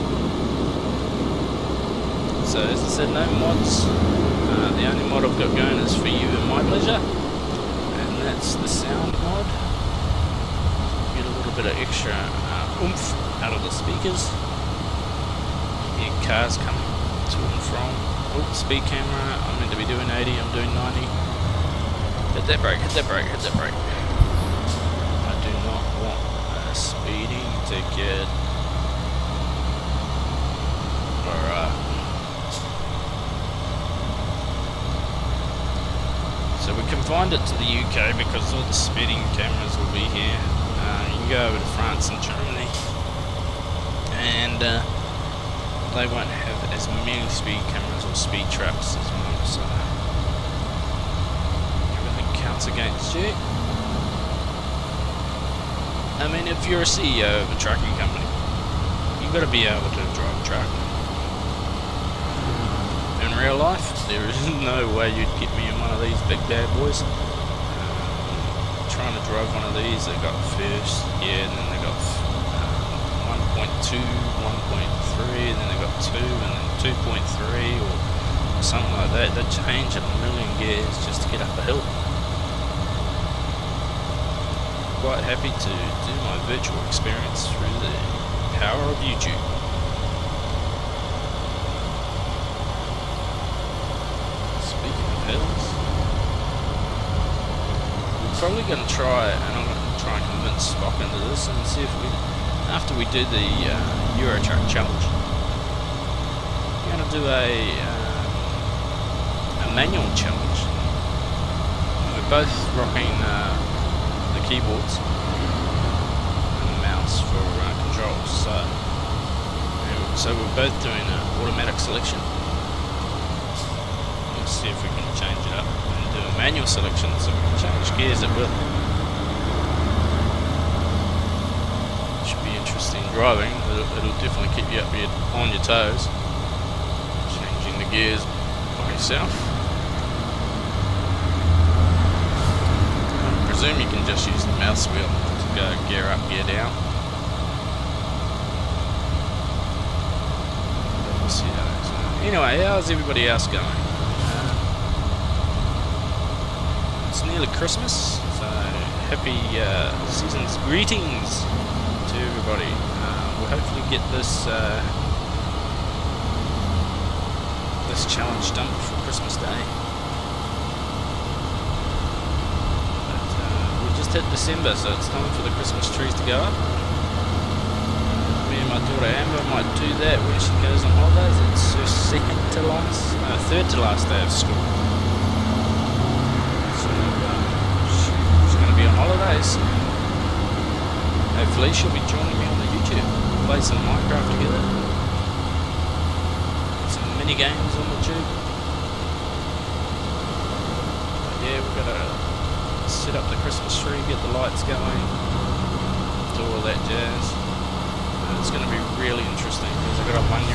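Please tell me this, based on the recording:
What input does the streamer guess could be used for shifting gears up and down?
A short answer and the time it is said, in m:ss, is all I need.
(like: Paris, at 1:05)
the mouse wheel, at 2:24.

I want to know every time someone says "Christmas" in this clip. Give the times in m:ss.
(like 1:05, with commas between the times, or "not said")
2:37, 2:49, 2:55, 3:23.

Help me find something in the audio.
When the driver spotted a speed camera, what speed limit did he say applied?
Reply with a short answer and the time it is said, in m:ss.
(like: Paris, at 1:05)
80, at 0:20.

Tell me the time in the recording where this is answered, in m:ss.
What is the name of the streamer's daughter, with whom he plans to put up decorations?
2:59.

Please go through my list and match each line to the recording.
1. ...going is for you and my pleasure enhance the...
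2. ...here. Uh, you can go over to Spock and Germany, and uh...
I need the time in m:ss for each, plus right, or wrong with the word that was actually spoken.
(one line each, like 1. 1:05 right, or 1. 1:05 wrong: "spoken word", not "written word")
1. 0:05 right
2. 0:40 wrong: "France", not "Spock".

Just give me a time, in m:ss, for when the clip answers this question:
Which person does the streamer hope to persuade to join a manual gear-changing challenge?
1:40.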